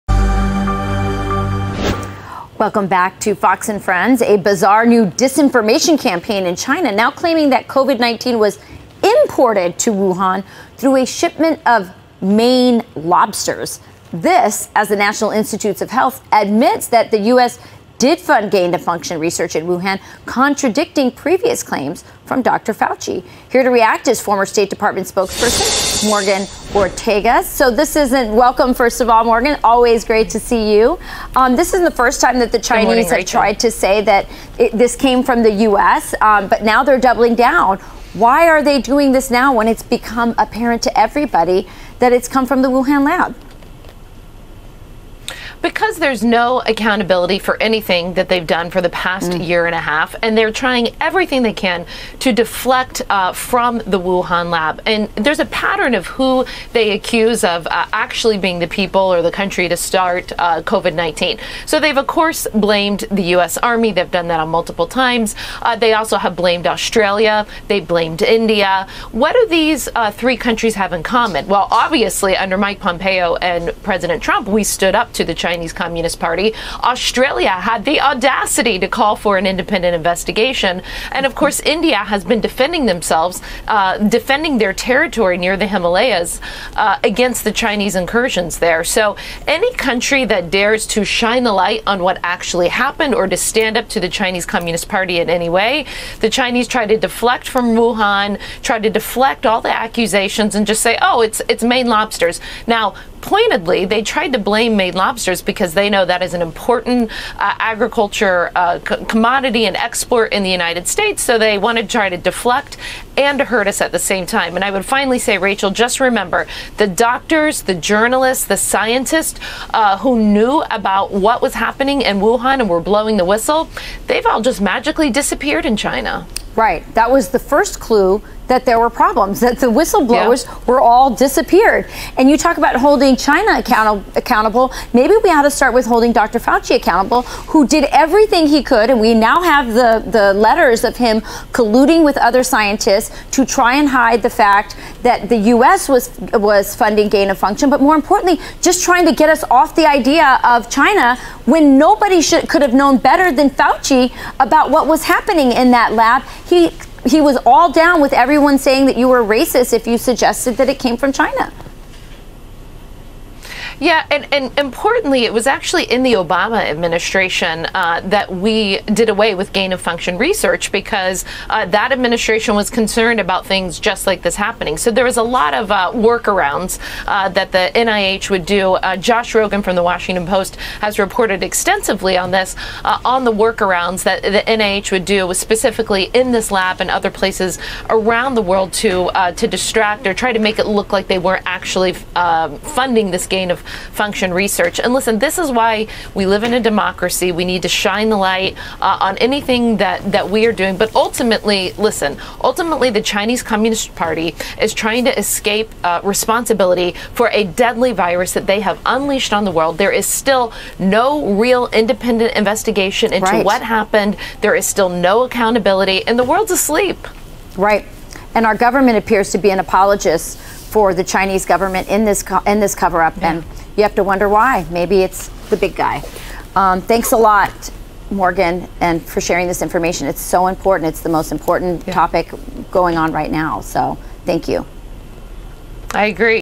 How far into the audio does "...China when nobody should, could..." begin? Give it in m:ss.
2:30.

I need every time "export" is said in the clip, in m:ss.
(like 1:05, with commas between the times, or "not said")
1:49.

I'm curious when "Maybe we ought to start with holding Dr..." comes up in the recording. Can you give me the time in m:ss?
2:14.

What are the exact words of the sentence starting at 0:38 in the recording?
Why are they doing this now when it's become apparent to everybody that it's come from the Wuhan lab?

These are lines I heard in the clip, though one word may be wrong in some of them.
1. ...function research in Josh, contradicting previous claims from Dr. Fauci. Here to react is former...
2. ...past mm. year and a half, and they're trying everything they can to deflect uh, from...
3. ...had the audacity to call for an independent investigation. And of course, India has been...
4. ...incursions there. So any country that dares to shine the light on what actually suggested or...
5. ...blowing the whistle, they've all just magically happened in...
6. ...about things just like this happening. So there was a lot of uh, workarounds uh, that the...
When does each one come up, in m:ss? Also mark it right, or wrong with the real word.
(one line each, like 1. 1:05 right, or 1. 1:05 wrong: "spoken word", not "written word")
1. 0:18 wrong: "Wuhan", not "Josh"
2. 0:48 right
3. 1:17 right
4. 1:27 wrong: "happened", not "suggested"
5. 2:02 wrong: "disappeared", not "happened"
6. 2:53 right.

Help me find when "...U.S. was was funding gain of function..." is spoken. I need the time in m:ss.
2:25.